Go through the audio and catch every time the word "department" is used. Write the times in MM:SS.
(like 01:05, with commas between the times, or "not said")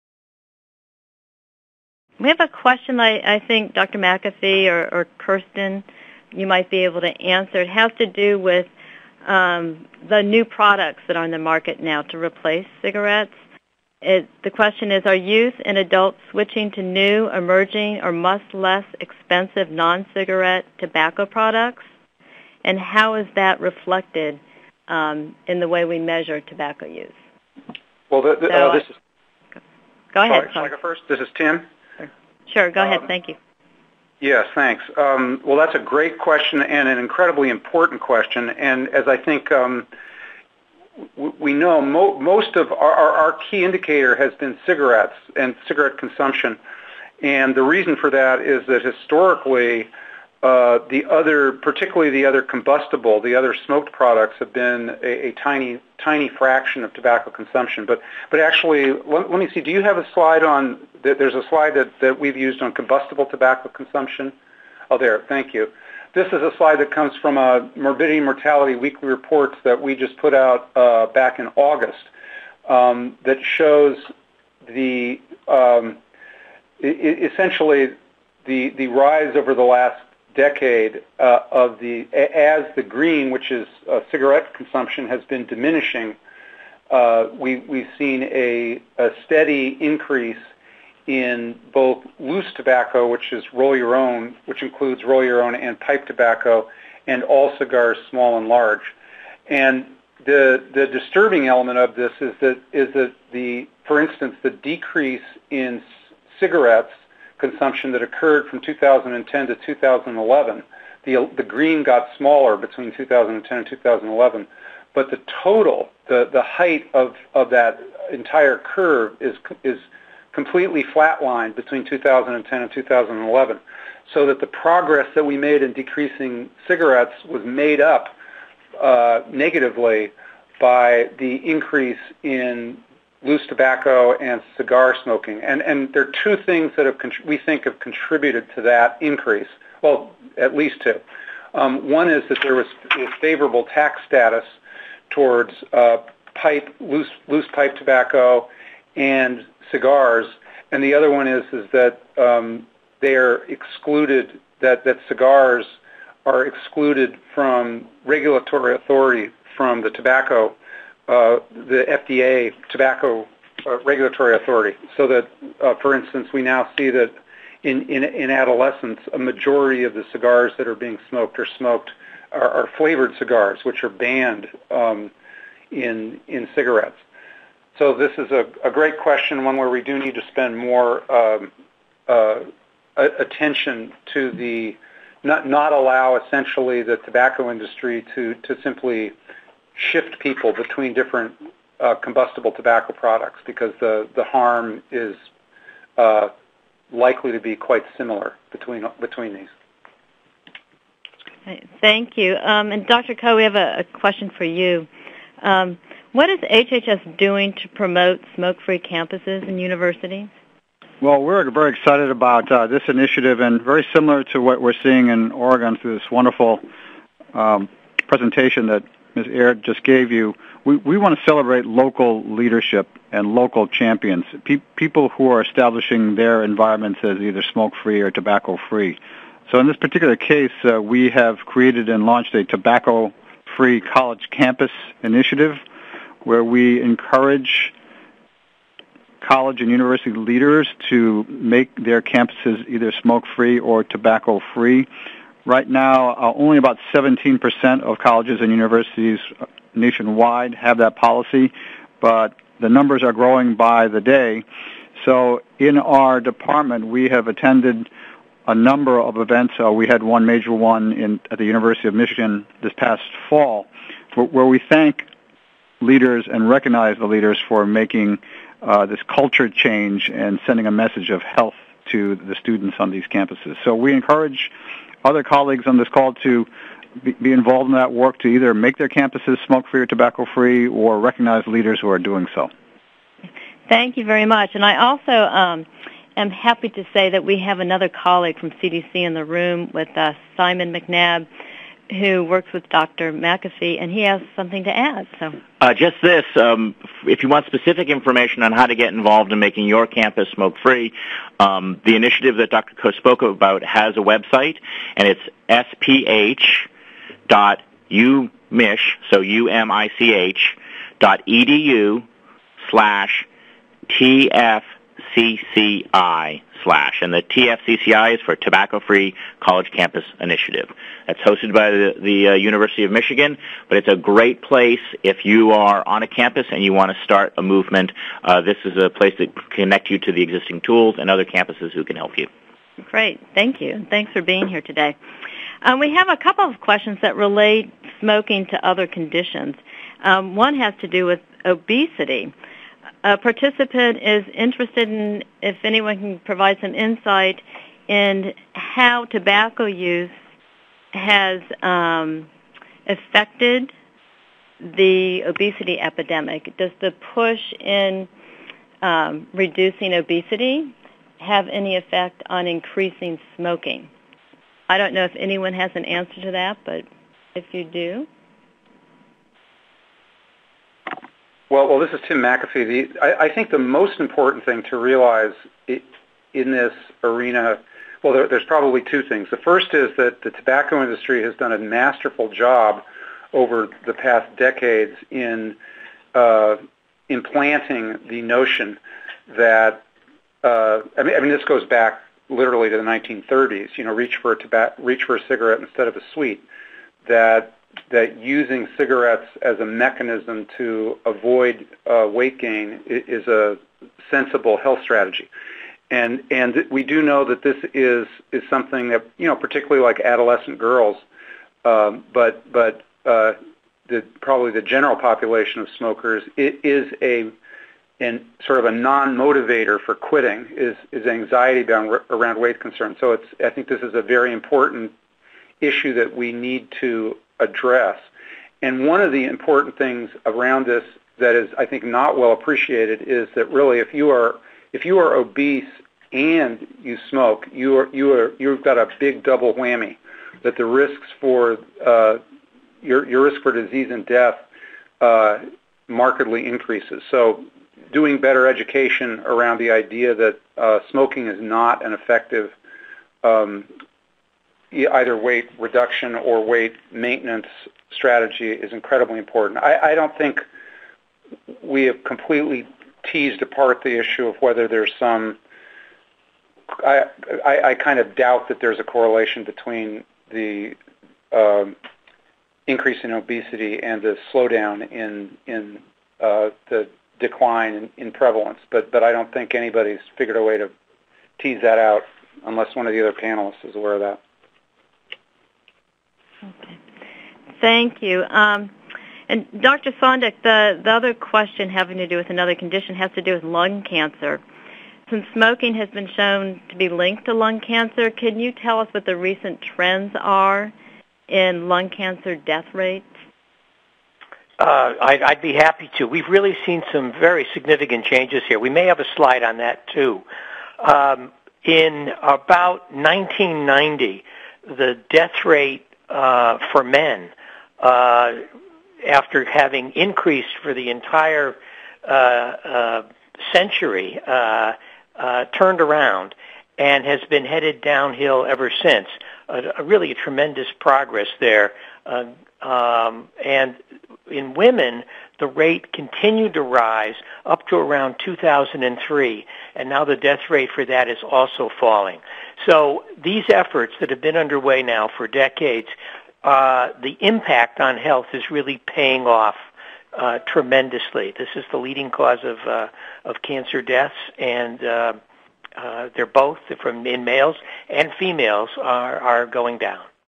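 04:16.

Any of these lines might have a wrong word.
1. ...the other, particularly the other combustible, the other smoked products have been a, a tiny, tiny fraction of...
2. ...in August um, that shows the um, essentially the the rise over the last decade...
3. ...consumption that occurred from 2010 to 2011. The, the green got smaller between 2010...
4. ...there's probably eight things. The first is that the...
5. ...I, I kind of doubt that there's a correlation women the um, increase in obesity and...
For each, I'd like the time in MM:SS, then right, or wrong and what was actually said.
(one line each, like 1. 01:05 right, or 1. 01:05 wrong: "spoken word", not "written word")
1. 00:50 right
2. 01:11 right
3. 01:47 right
4. 06:18 wrong: "two", not "eight"
5. 07:47 wrong: "between", not "women".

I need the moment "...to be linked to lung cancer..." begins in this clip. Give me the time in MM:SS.
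08:16.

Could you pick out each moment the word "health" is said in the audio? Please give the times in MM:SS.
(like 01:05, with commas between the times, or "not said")
04:31, 06:44, 09:07.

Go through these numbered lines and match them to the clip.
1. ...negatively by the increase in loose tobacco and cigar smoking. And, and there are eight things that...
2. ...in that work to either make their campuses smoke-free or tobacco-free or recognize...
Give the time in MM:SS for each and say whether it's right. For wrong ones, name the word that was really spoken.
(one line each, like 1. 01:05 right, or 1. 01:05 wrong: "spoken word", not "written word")
1. 02:09 wrong: "two", not "eight"
2. 04:37 right.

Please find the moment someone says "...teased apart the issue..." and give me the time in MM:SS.
07:43.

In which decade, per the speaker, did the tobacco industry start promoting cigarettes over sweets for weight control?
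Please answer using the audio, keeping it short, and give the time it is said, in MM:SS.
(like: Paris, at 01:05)
1930s, at 06:32.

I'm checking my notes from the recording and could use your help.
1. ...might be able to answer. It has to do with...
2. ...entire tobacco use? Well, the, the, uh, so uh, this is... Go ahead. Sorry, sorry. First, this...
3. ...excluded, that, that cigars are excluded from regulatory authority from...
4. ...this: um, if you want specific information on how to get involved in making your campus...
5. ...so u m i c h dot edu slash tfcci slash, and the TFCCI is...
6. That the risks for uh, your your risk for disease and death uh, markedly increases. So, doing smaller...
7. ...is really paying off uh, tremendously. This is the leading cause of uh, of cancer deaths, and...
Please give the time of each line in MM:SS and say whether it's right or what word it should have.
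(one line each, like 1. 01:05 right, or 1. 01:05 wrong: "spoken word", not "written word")
1. 00:06 right
2. 00:25 wrong: "measure", not "entire"
3. 02:33 right
4. 04:56 right
5. 05:09 right
6. 07:20 wrong: "better", not "smaller"
7. 09:08 right.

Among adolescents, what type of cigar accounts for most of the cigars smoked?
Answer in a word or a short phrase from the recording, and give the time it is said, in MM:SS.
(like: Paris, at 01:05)
Flavored cigars, at 02:52.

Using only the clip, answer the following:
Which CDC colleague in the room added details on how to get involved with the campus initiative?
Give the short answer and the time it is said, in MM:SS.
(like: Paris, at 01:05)
Simon McNabb, at 04:50.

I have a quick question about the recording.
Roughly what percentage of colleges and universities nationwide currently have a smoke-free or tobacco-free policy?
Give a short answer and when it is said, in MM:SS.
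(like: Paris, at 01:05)
17%, at 04:06.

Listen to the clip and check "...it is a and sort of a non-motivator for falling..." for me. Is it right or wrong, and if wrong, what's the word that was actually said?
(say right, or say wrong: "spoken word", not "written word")
wrong: "quitting", not "falling".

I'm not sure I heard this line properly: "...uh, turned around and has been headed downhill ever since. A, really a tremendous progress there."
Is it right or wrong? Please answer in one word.
right.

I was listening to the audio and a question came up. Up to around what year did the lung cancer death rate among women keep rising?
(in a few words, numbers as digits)
2003.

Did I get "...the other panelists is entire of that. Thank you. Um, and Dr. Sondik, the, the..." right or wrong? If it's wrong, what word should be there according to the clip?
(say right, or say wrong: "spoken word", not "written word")
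wrong: "aware", not "entire".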